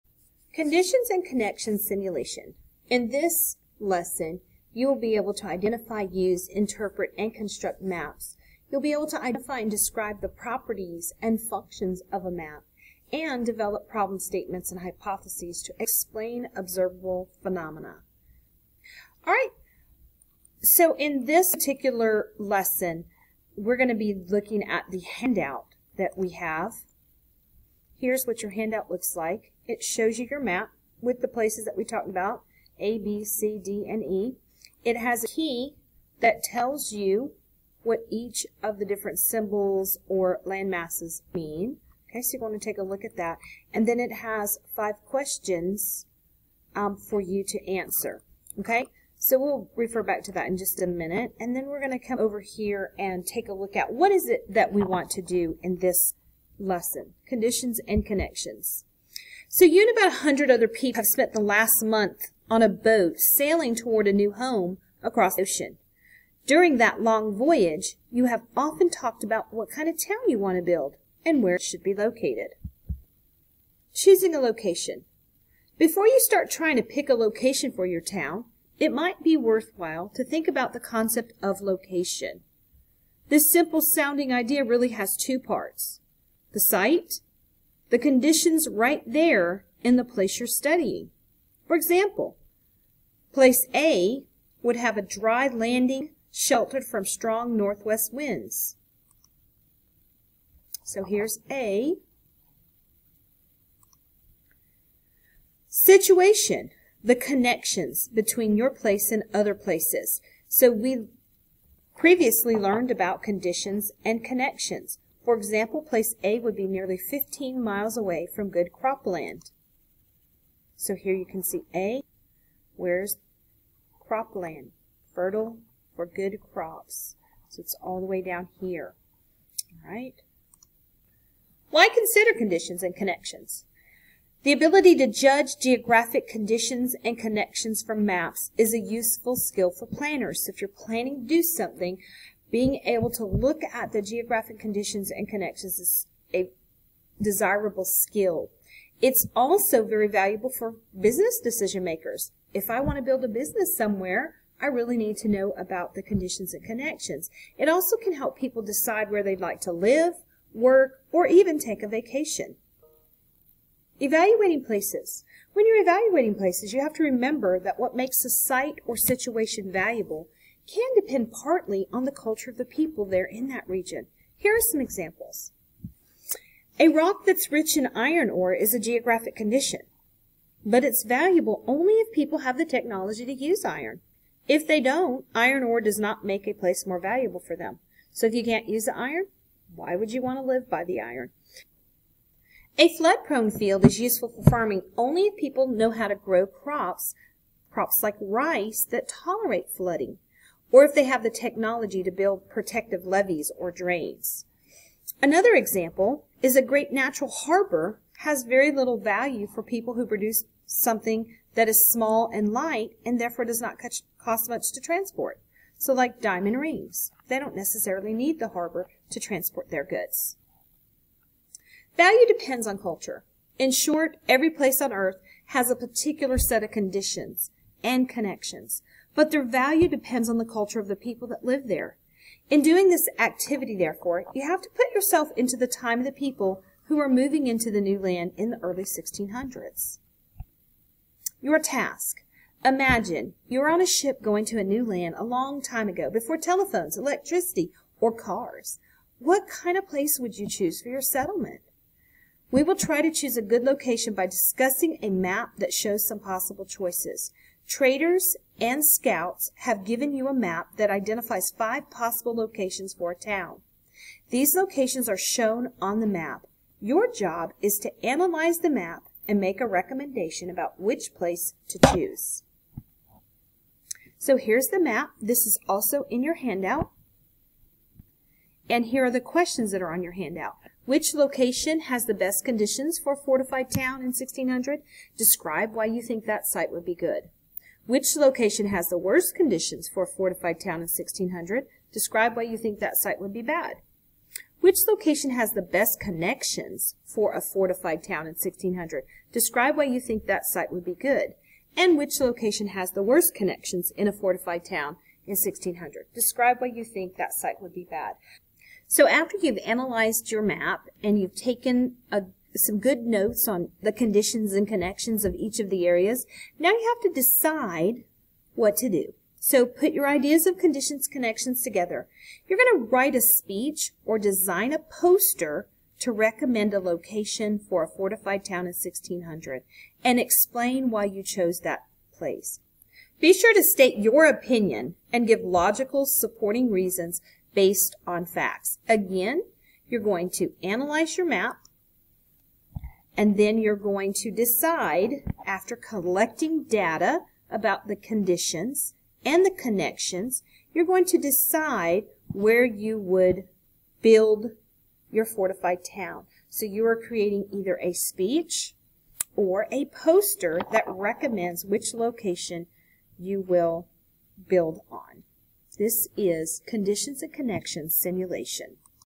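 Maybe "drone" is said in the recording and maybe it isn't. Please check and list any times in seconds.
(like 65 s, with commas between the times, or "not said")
not said.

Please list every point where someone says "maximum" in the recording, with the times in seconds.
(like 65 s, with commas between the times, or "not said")
not said.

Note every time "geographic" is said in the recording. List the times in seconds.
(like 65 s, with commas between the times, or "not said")
135 s, 144 s, 178 s.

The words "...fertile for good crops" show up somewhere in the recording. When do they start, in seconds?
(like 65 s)
125 s.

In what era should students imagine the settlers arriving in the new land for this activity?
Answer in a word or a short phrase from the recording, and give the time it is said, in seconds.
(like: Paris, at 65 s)
early 1600s, at 238 s.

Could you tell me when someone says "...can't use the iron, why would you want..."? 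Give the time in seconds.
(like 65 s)
188 s.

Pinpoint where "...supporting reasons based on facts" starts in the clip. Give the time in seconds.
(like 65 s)
336 s.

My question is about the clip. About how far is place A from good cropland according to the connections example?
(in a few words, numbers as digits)
nearly 15 miles.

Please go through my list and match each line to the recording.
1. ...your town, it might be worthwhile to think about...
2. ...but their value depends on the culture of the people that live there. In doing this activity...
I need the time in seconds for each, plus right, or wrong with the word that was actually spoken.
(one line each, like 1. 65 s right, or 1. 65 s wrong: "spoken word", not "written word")
1. 77 s right
2. 229 s right.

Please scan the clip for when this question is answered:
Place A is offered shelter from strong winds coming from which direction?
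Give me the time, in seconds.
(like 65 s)
97 s.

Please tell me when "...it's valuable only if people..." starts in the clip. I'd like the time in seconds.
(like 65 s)
180 s.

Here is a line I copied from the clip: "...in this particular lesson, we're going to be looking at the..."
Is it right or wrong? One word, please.
right.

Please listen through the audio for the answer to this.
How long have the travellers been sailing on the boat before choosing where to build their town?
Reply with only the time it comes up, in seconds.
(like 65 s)
61 s.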